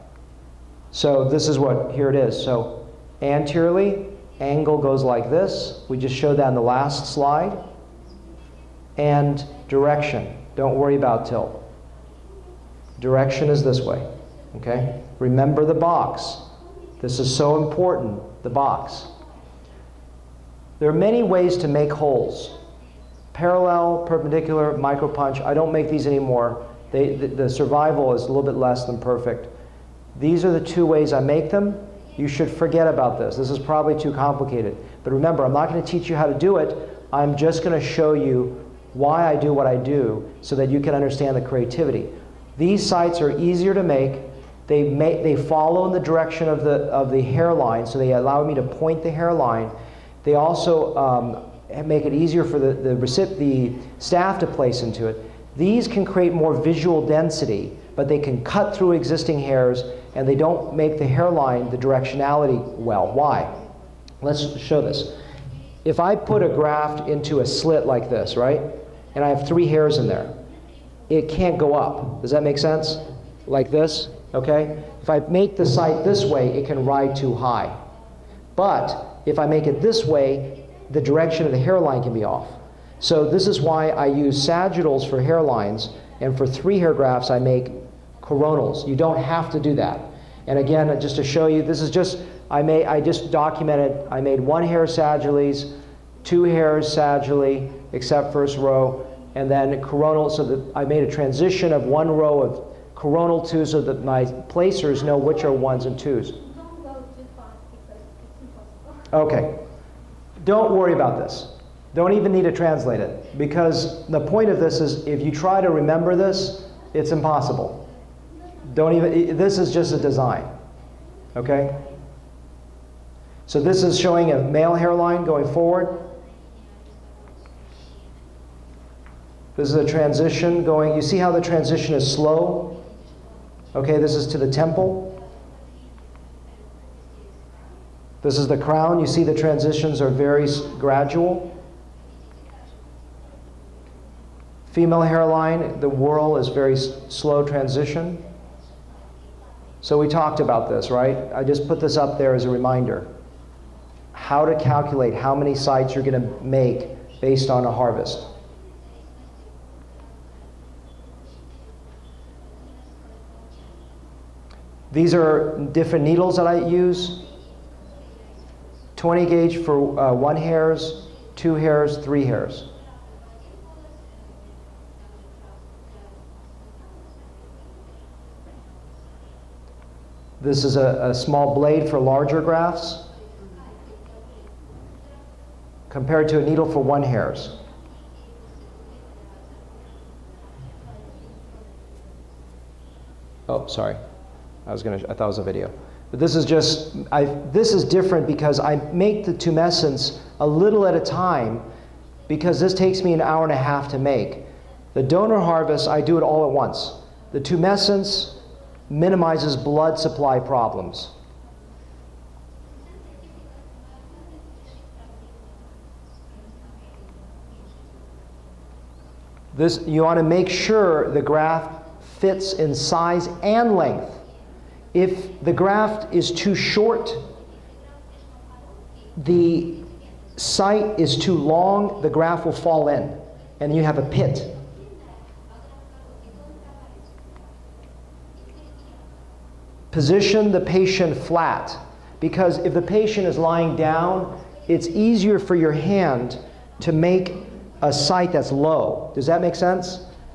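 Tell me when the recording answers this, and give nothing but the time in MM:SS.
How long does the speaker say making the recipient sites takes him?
03:23.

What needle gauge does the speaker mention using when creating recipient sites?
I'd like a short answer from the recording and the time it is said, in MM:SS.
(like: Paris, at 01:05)
20 gauge, at 02:48.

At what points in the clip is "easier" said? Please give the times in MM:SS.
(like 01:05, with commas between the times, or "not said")
00:43, 00:52, 04:04.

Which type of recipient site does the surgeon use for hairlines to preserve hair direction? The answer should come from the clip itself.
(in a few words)
Sagittals.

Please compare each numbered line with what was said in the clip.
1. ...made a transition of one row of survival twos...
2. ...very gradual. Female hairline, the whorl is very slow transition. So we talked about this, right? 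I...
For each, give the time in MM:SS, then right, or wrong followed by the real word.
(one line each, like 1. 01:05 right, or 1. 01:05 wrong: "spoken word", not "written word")
1. 01:40 wrong: "coronal", not "survival"
2. 02:20 right.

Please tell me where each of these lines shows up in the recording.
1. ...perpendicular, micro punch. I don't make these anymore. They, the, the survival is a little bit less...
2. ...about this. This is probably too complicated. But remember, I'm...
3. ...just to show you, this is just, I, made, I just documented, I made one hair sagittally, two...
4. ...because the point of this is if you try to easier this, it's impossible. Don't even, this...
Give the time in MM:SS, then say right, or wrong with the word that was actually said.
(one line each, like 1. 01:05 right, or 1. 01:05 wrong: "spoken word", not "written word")
1. 00:24 right
2. 00:32 right
3. 01:30 right
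4. 01:53 wrong: "remember", not "easier".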